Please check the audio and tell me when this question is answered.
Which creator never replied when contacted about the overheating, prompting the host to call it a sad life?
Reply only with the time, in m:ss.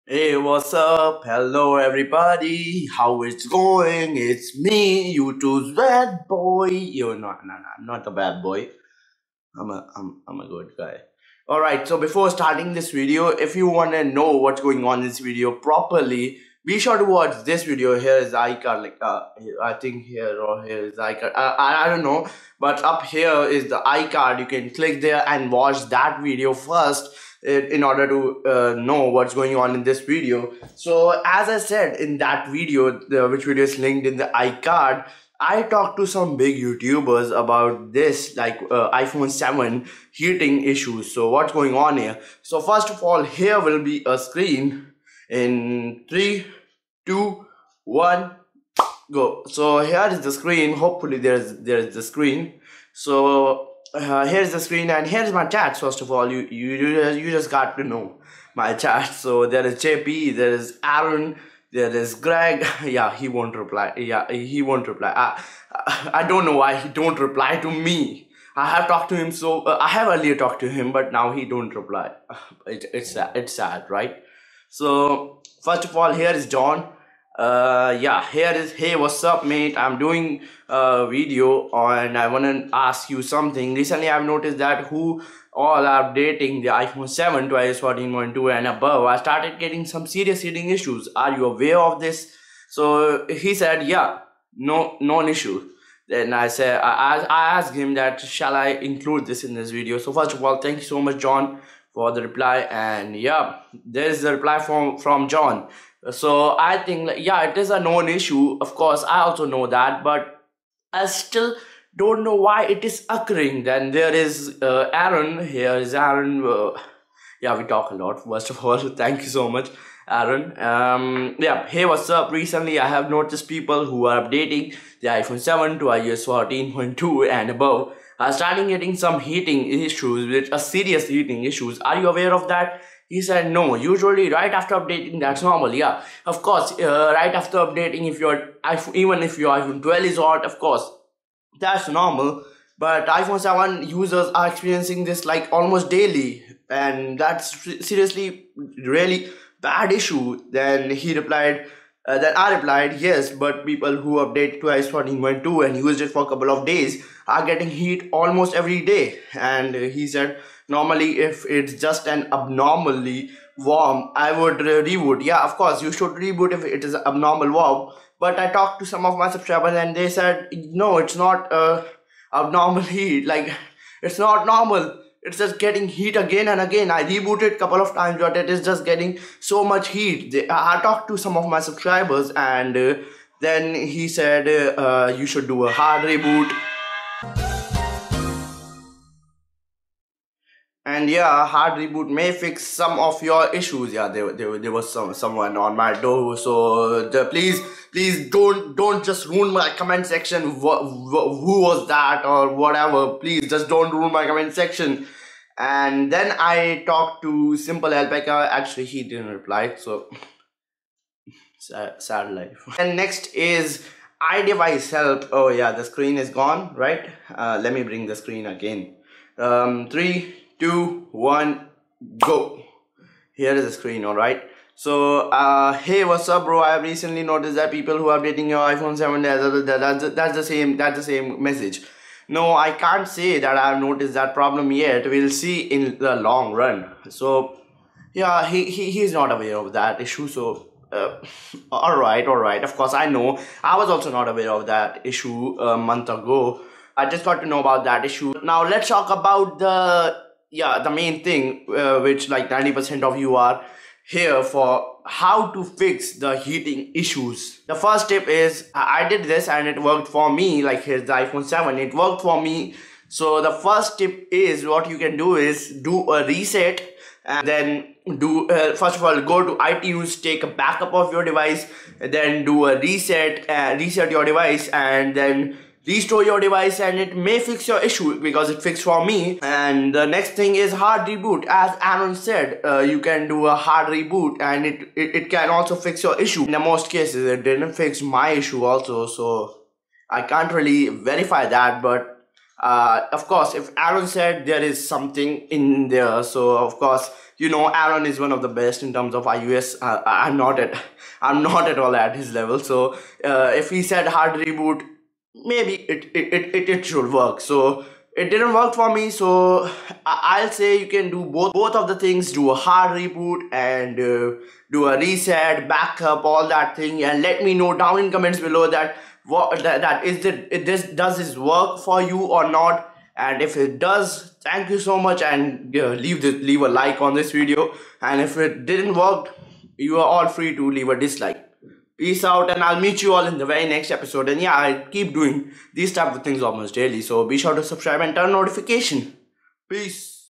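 3:27.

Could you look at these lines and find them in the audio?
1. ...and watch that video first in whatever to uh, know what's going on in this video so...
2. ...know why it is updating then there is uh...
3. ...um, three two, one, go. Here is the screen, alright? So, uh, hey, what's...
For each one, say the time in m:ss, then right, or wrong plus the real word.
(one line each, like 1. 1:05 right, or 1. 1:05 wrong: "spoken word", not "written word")
1. 0:25 wrong: "order", not "whatever"
2. 1:52 wrong: "occurring", not "updating"
3. 3:39 right.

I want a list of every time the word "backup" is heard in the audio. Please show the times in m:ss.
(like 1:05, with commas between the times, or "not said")
4:30, 5:15.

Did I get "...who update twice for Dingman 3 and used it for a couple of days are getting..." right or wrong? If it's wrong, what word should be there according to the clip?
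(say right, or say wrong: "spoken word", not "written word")
wrong: "2", not "3".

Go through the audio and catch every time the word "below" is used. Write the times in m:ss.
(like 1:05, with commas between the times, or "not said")
5:18.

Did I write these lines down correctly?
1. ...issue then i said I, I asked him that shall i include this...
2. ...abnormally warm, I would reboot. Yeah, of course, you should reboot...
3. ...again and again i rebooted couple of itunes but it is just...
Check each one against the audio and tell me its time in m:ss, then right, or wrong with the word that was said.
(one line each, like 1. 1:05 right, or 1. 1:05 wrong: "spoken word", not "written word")
1. 1:35 right
2. 2:42 right
3. 2:56 wrong: "times", not "itunes".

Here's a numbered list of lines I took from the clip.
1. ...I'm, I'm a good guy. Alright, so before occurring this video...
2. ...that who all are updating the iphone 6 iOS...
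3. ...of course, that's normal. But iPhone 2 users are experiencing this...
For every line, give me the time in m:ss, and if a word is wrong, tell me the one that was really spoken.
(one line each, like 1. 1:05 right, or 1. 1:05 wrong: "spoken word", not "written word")
1. 0:09 wrong: "starting", not "occurring"
2. 1:24 wrong: "7", not "6"
3. 2:20 wrong: "7", not "2".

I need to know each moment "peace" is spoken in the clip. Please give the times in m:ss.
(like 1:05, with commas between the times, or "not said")
5:32, 5:39.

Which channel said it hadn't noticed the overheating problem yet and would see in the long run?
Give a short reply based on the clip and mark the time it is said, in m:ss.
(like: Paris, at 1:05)
iDevice Help, at 3:34.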